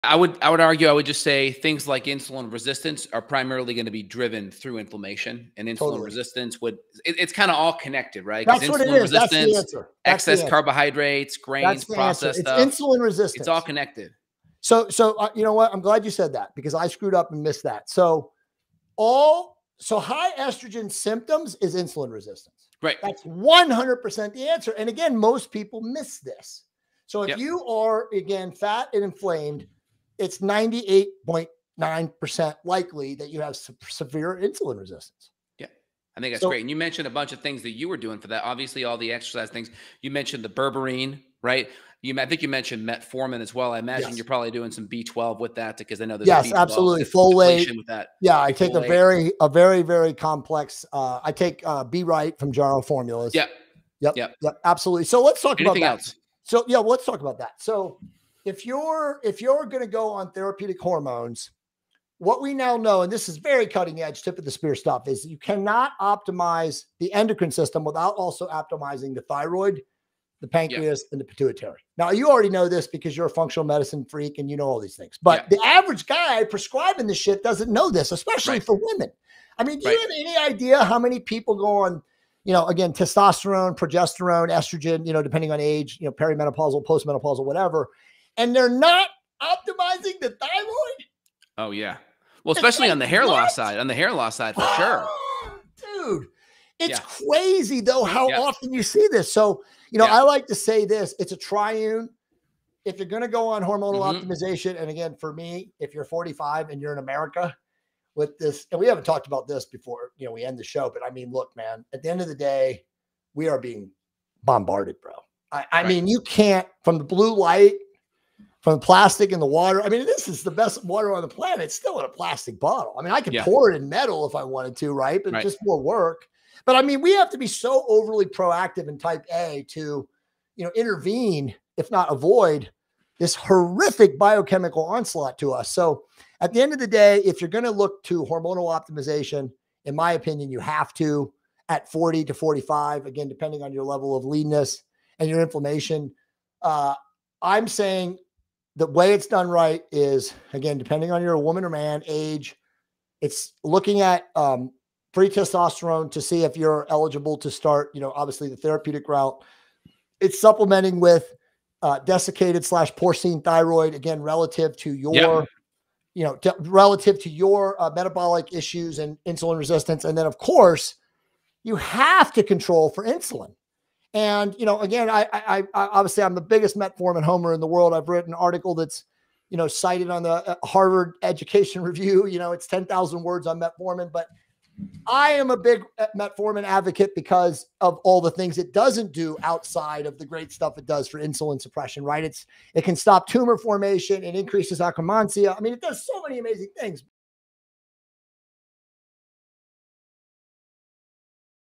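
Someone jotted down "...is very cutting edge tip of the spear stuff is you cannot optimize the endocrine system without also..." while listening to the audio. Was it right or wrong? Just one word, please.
right.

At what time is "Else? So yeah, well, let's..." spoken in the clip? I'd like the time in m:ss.
0:56.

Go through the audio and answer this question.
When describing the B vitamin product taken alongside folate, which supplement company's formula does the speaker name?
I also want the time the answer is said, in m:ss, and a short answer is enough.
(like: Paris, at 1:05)
Jarrow Formulas, at 0:52.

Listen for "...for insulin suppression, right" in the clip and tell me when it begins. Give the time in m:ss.
3:11.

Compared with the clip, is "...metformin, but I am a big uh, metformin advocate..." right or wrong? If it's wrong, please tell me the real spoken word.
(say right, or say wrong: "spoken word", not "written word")
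right.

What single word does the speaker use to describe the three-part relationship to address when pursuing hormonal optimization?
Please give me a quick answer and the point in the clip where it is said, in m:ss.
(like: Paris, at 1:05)
triune, at 1:41.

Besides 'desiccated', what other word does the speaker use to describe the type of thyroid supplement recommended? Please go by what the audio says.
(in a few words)
porcine.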